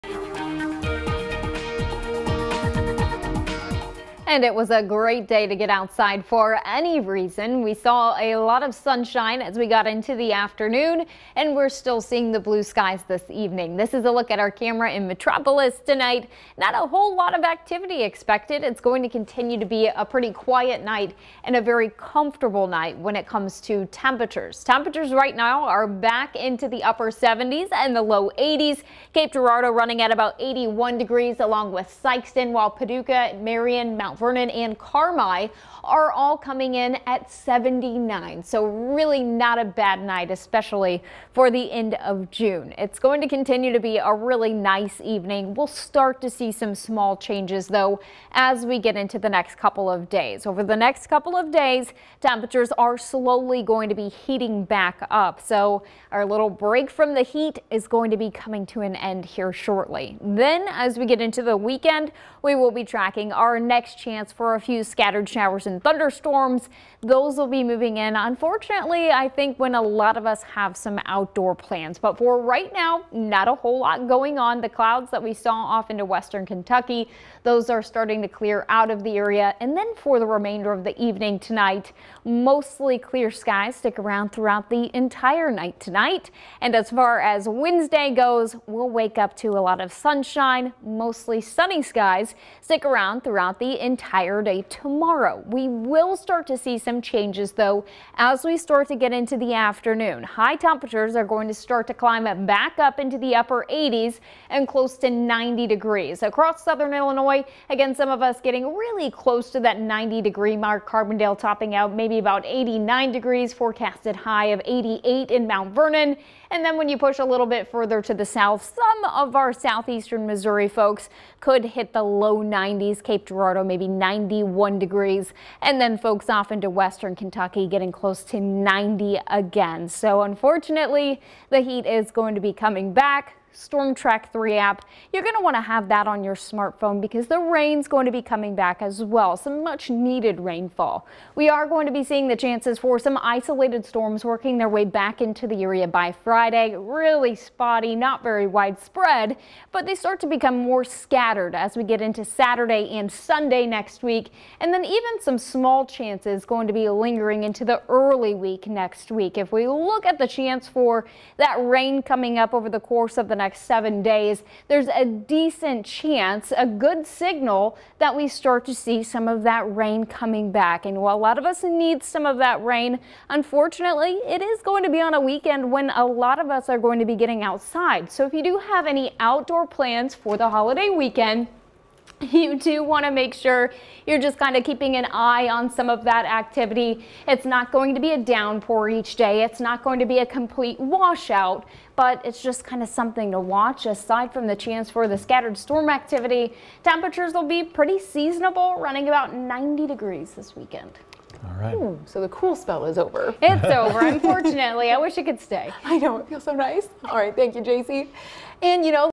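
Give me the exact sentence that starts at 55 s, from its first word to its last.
So our little break from the heat is going to be coming to an end here shortly.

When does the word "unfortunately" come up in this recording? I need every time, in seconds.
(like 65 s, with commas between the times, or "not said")
68 s, 130 s, 173 s, 204 s.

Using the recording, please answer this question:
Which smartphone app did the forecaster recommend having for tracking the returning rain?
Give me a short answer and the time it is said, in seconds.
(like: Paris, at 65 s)
Storm Track 3, at 133 s.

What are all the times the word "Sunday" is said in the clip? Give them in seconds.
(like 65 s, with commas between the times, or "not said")
153 s.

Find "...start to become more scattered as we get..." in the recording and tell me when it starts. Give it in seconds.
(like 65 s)
149 s.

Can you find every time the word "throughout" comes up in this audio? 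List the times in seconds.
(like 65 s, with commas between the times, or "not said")
84 s, 93 s.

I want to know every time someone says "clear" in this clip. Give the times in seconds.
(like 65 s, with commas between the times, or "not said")
78 s, 82 s.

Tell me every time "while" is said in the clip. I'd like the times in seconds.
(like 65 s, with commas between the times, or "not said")
32 s, 171 s.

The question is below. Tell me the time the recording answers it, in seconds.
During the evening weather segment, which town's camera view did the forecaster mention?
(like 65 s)
15 s.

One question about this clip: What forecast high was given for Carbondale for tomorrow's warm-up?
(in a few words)
89 degrees.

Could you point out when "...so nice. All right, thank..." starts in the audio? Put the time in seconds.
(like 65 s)
206 s.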